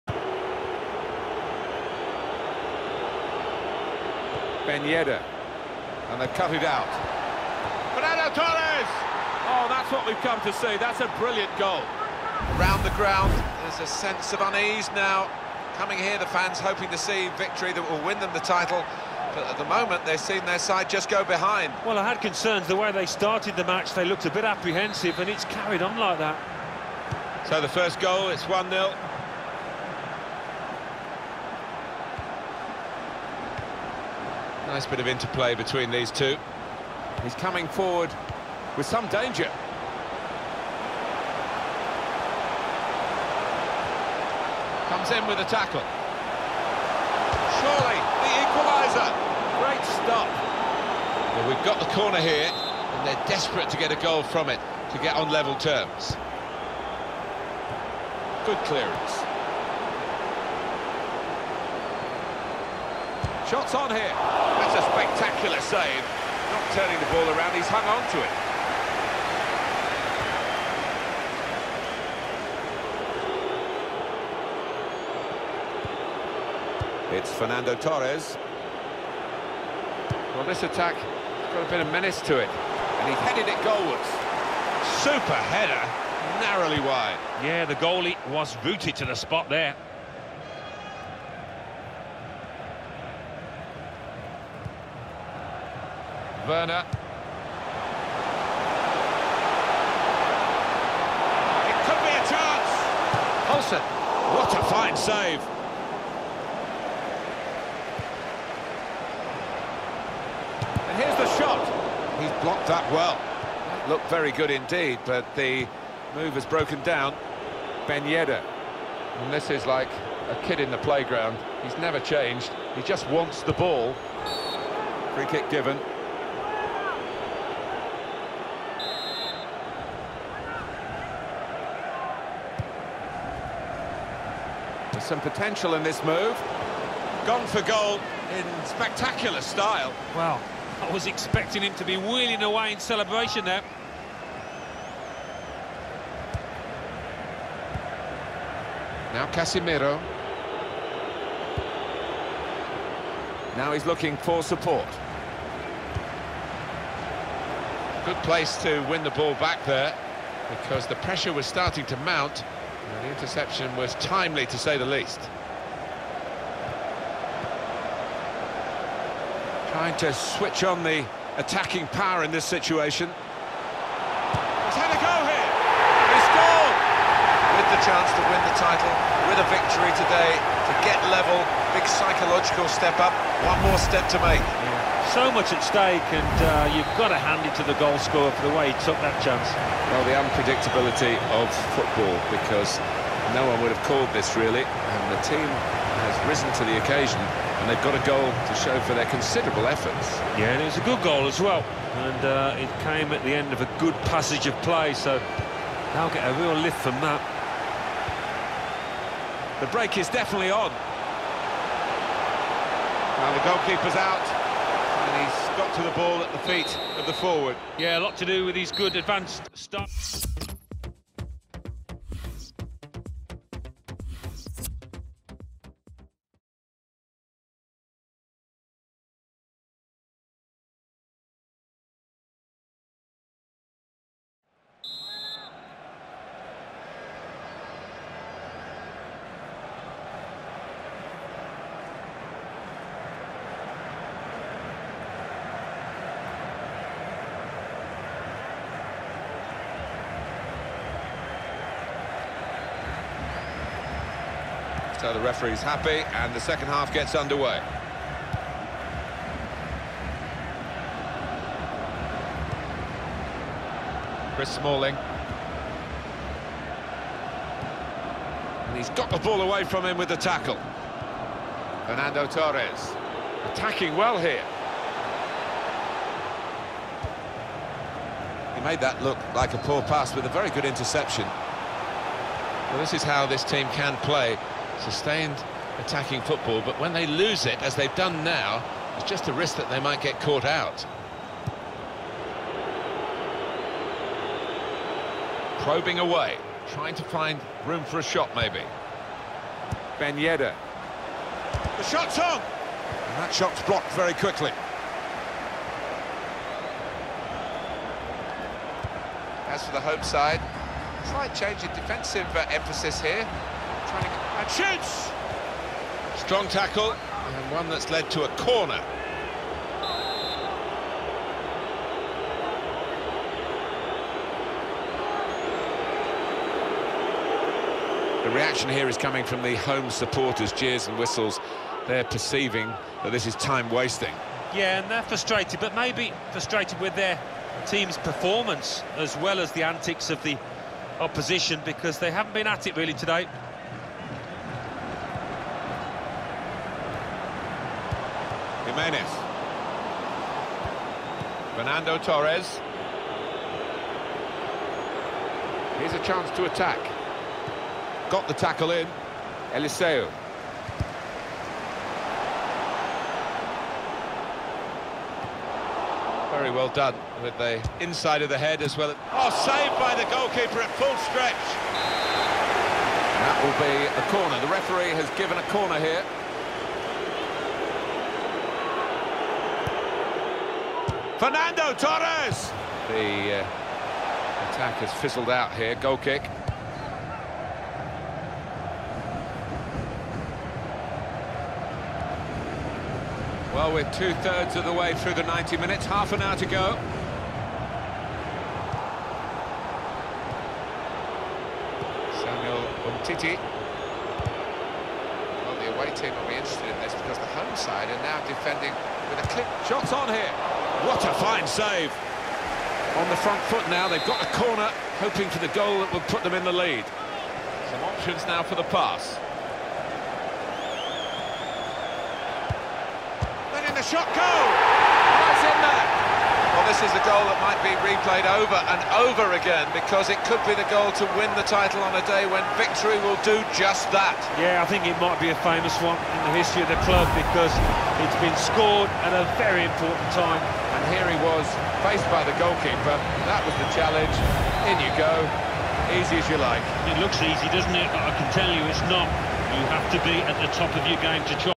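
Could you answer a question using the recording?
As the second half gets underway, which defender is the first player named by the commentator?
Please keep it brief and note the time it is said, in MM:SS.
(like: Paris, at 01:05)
Chris Smalling, at 04:24.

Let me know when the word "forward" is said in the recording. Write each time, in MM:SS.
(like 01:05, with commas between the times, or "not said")
00:37, 03:37.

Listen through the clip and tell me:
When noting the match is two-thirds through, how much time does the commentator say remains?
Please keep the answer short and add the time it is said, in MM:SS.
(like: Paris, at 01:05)
Half an hour, at 06:35.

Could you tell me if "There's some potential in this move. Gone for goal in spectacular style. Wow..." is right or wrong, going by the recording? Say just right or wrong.
right.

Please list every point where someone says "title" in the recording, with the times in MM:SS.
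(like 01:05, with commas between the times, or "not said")
00:18, 02:58, 07:11.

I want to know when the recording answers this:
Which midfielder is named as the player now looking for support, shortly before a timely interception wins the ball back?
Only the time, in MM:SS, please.
02:29.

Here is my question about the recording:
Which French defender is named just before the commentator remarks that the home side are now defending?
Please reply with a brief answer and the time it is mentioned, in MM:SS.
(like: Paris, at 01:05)
Samuel Umtiti, at 06:42.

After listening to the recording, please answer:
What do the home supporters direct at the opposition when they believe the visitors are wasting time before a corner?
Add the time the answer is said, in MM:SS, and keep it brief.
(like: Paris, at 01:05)
Jeers and whistles, at 05:30.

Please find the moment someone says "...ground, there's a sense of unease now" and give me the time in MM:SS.
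00:12.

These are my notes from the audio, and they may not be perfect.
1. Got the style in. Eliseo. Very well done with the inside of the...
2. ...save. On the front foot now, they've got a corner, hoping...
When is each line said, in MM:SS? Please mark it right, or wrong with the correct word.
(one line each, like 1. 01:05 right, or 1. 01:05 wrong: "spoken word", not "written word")
1. 05:58 wrong: "tackle", not "style"
2. 06:51 right.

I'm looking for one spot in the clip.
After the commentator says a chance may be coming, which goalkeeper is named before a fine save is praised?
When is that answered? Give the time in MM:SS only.
01:43.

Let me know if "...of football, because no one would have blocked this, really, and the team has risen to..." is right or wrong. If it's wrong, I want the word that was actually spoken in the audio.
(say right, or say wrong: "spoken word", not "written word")
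wrong: "called", not "blocked".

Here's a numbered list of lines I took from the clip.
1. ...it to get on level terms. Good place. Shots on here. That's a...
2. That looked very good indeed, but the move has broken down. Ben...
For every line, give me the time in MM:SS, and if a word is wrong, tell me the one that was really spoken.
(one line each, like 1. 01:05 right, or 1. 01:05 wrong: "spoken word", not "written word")
1. 00:54 wrong: "clearance", not "place"
2. 01:53 right.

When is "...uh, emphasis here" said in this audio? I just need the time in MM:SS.
05:12.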